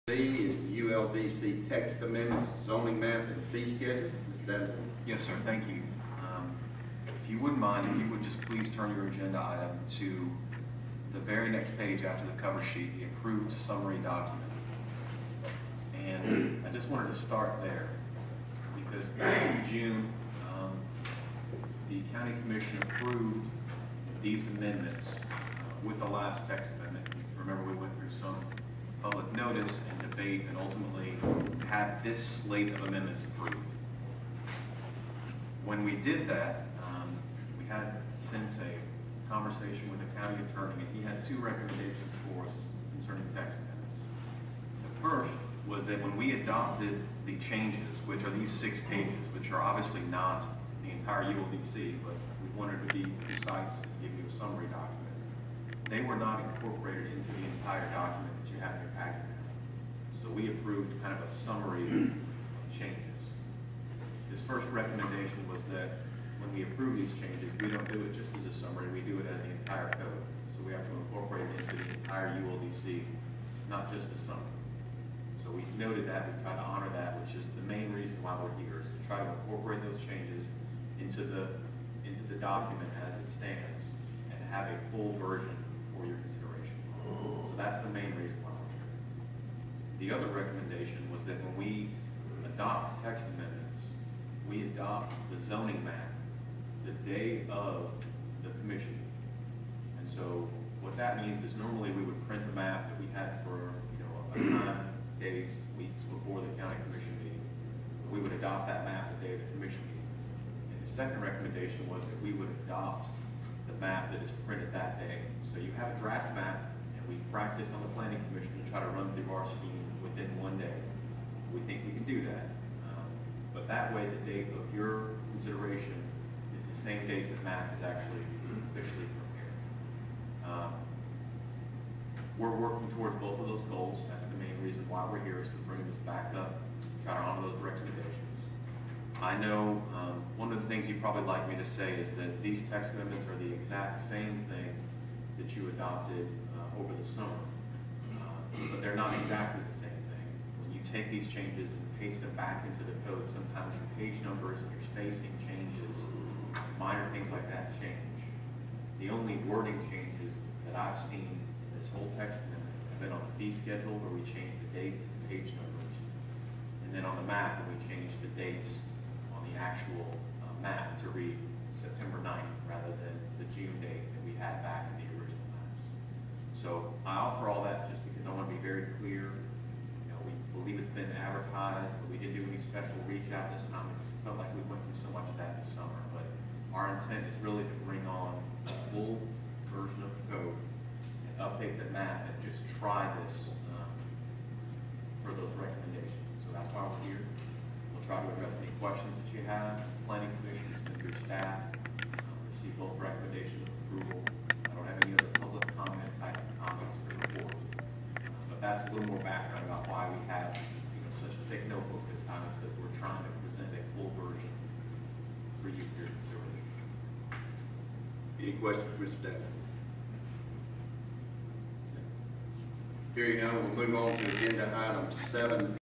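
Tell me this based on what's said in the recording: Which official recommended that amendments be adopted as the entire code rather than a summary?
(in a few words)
county attorney.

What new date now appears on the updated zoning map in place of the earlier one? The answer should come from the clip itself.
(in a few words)
September 9th.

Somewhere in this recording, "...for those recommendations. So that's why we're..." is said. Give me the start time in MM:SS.
03:15.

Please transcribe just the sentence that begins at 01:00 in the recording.
So we approved kind of a summary of changes.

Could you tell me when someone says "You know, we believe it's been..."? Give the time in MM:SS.
02:59.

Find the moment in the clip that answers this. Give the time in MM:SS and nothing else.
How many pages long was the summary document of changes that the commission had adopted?
00:48.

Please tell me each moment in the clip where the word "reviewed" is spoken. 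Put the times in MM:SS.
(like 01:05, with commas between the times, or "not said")
not said.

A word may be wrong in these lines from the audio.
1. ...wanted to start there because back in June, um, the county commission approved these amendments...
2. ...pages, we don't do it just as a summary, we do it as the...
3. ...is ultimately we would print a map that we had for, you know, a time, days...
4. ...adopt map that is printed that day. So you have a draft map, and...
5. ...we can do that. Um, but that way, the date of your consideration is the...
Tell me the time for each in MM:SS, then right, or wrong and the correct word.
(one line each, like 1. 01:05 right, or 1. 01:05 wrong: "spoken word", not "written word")
1. 00:16 right
2. 01:07 wrong: "changes", not "pages"
3. 01:41 wrong: "normally", not "ultimately"
4. 01:52 right
5. 02:01 right.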